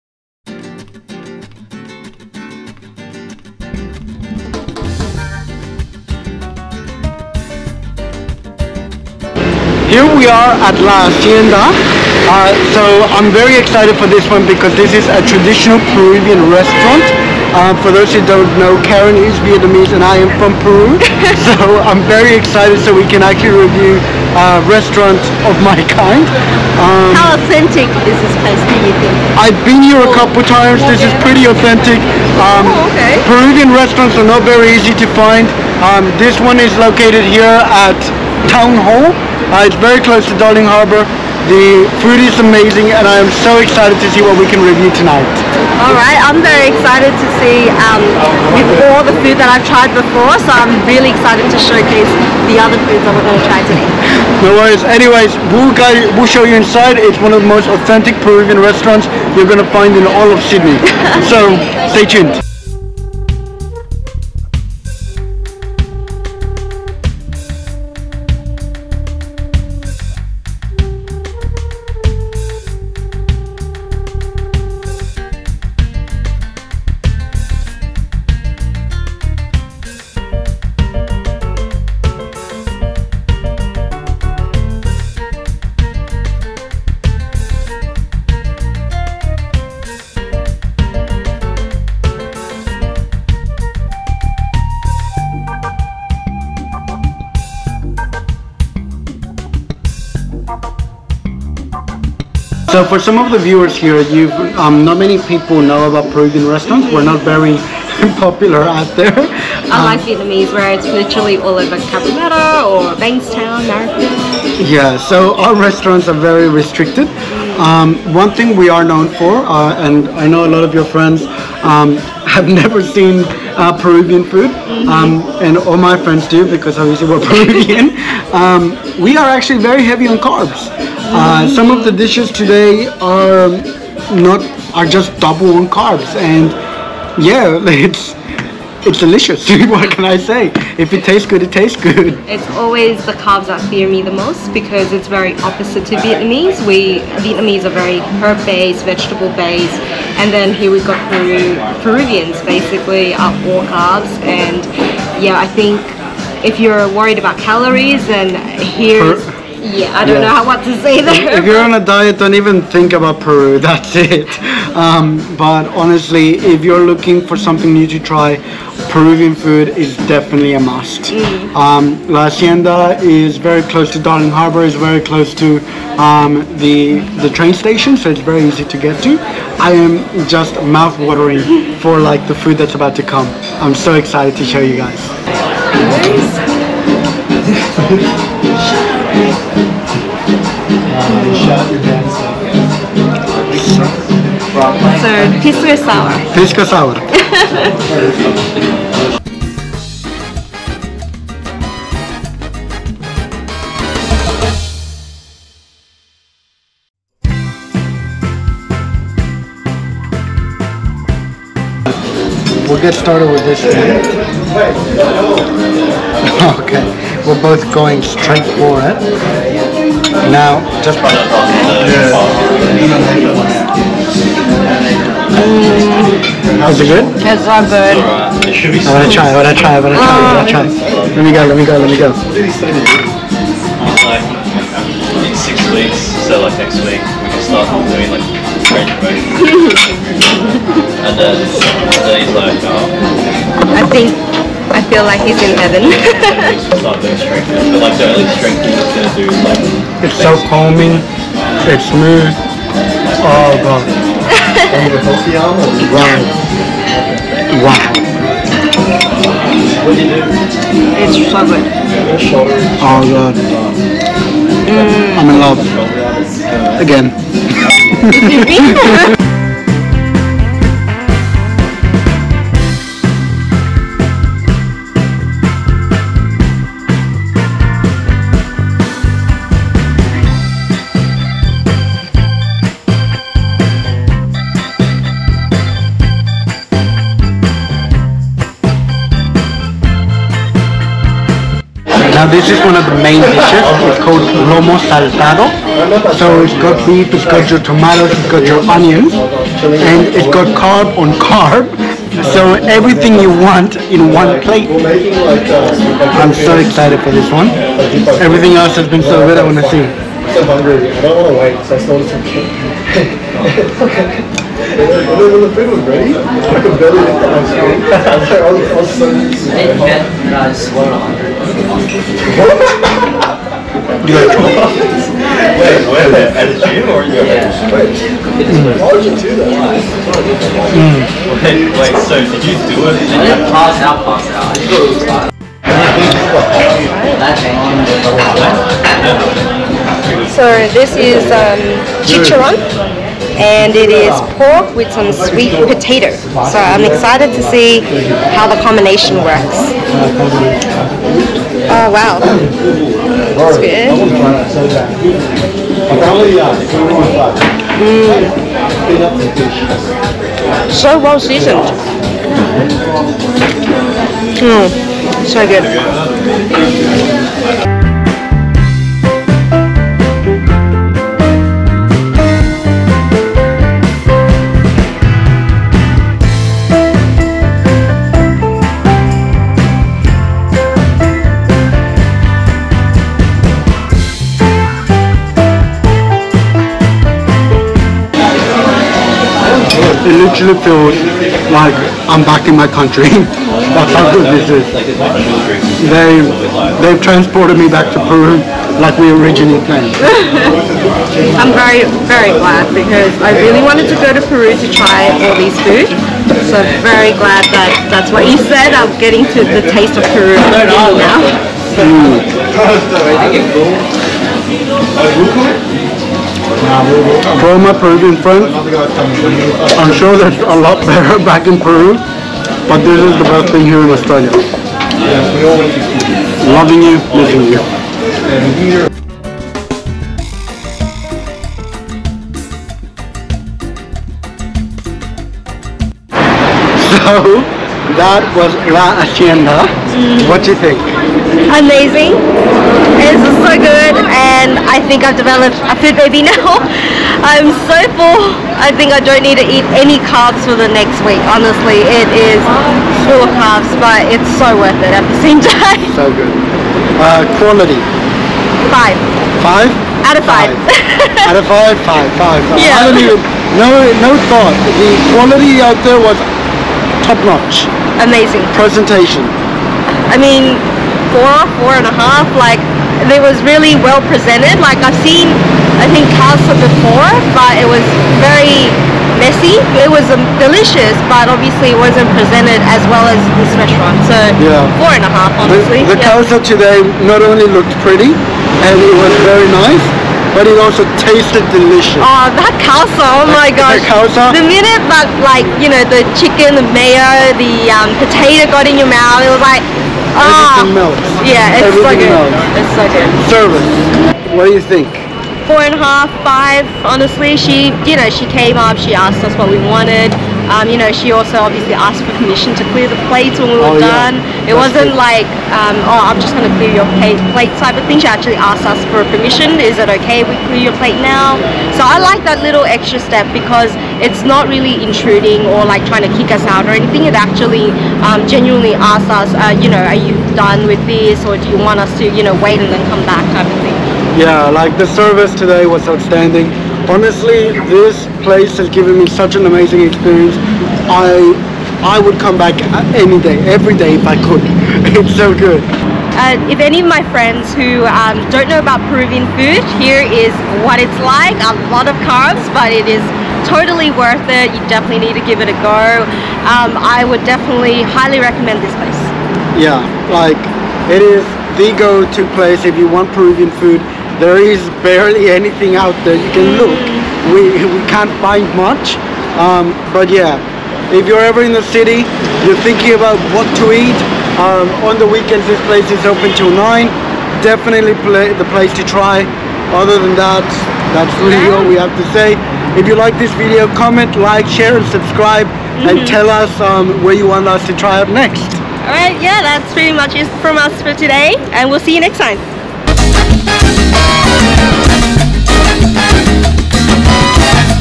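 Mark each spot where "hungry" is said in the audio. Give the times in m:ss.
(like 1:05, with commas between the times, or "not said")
5:10.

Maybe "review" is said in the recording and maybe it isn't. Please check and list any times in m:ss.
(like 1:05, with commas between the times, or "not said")
0:23, 0:44.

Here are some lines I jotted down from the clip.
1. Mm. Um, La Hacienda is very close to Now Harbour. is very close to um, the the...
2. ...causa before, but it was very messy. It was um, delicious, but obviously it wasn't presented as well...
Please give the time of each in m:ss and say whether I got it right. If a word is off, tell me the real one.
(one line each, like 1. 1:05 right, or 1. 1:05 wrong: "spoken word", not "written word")
1. 2:51 wrong: "Darling", not "Now"
2. 7:56 right.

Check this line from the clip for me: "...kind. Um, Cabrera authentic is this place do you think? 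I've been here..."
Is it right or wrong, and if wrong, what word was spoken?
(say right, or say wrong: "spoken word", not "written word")
wrong: "How", not "Cabrera".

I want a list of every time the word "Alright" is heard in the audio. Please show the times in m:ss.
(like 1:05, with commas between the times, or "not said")
0:45, 9:48.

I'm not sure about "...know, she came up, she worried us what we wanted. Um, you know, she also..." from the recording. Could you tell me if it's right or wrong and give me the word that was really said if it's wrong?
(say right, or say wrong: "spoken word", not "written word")
wrong: "asked", not "worried".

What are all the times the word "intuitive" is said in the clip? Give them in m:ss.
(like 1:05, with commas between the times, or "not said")
not said.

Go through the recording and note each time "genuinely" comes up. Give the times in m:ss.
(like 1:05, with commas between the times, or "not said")
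8:48.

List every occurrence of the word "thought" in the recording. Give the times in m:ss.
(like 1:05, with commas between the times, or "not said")
7:44.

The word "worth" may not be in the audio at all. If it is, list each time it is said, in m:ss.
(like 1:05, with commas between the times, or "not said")
7:34, 9:13.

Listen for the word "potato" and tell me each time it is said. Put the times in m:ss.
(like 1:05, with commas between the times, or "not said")
5:45, 8:17.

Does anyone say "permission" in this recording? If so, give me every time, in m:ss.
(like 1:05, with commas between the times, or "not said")
8:32, 8:39.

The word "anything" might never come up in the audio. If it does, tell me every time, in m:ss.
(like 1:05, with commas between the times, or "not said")
8:46, 9:25.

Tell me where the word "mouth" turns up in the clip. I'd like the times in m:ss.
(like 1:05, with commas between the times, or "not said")
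3:00, 8:18.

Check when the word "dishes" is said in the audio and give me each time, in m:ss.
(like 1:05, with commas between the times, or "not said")
2:11, 4:53.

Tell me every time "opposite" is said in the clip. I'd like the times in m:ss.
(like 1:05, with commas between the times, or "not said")
2:25.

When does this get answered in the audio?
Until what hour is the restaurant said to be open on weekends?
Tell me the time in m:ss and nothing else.
9:36.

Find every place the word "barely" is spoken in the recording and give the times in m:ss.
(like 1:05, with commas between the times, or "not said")
5:16, 9:24.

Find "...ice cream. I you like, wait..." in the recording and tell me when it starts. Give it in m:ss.
5:20.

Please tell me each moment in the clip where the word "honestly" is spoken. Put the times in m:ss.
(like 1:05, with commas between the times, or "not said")
2:45, 7:31, 8:05, 8:26, 8:56.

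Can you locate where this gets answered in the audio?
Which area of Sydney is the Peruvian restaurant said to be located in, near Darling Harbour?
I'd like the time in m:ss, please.
0:38.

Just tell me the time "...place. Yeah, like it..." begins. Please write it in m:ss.
9:18.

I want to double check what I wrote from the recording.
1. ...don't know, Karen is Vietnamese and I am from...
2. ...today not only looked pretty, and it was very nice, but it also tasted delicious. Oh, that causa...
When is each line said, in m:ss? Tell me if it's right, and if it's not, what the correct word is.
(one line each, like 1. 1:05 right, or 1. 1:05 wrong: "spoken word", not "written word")
1. 0:18 right
2. 8:06 right.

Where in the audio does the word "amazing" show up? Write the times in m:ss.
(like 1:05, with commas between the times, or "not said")
0:42, 7:21, 7:47, 8:59.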